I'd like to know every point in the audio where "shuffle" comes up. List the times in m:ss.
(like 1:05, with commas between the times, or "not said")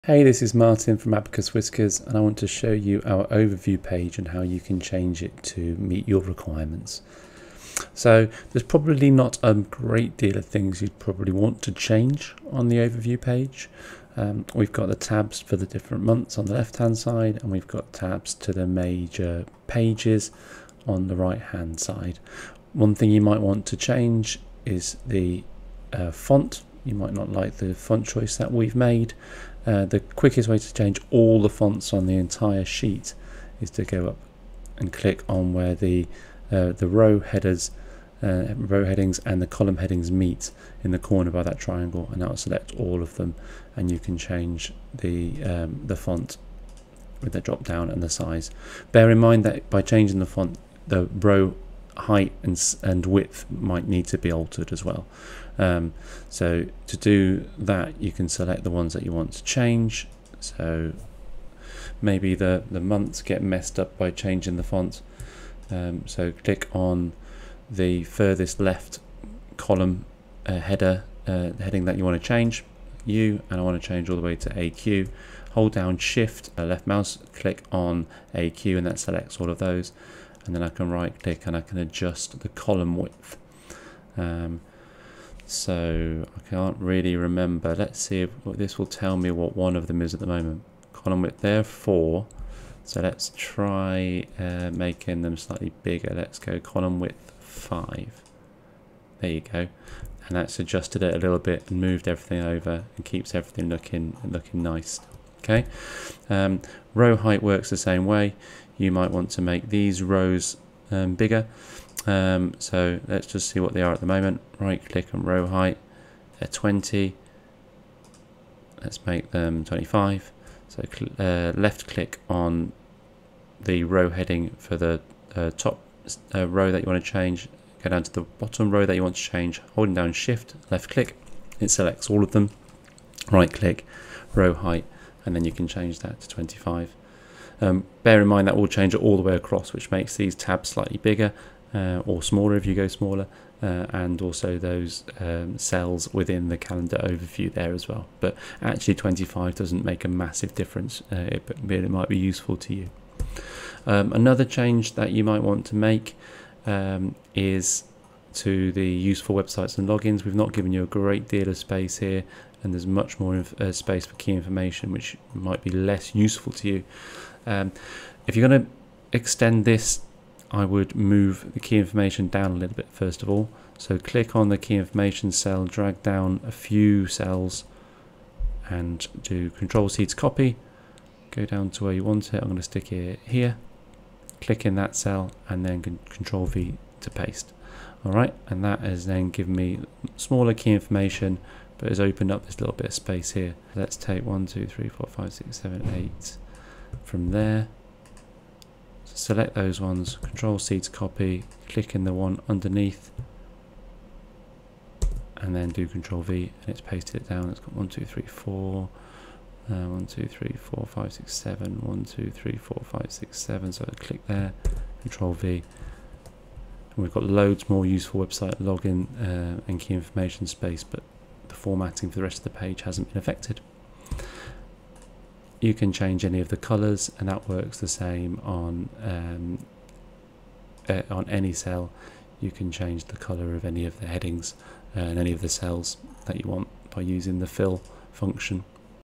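not said.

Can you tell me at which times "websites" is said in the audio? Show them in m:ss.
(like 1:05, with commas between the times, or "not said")
2:39, 3:38.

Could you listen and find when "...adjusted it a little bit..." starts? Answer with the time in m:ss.
1:40.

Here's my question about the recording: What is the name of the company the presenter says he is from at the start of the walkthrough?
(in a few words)
Abacus Whiskers.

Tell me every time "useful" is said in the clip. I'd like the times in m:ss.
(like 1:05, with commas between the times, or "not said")
2:32, 2:38, 2:46, 3:37.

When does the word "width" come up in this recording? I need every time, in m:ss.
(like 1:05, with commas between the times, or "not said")
0:53, 1:22, 1:31, 1:37.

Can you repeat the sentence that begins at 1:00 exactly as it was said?
So maybe the, the months get messed up by changing the font.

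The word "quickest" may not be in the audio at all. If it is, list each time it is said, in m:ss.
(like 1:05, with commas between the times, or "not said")
0:29.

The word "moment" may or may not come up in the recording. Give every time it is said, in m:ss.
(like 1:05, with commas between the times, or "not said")
1:30, 1:54.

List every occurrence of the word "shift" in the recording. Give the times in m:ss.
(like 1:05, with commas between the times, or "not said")
1:15, 2:10.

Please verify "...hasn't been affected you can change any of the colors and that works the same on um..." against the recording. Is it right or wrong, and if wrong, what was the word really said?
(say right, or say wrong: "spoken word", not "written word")
right.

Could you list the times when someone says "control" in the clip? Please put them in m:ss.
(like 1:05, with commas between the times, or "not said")
2:59, 3:06, 3:20, 3:25, 3:35.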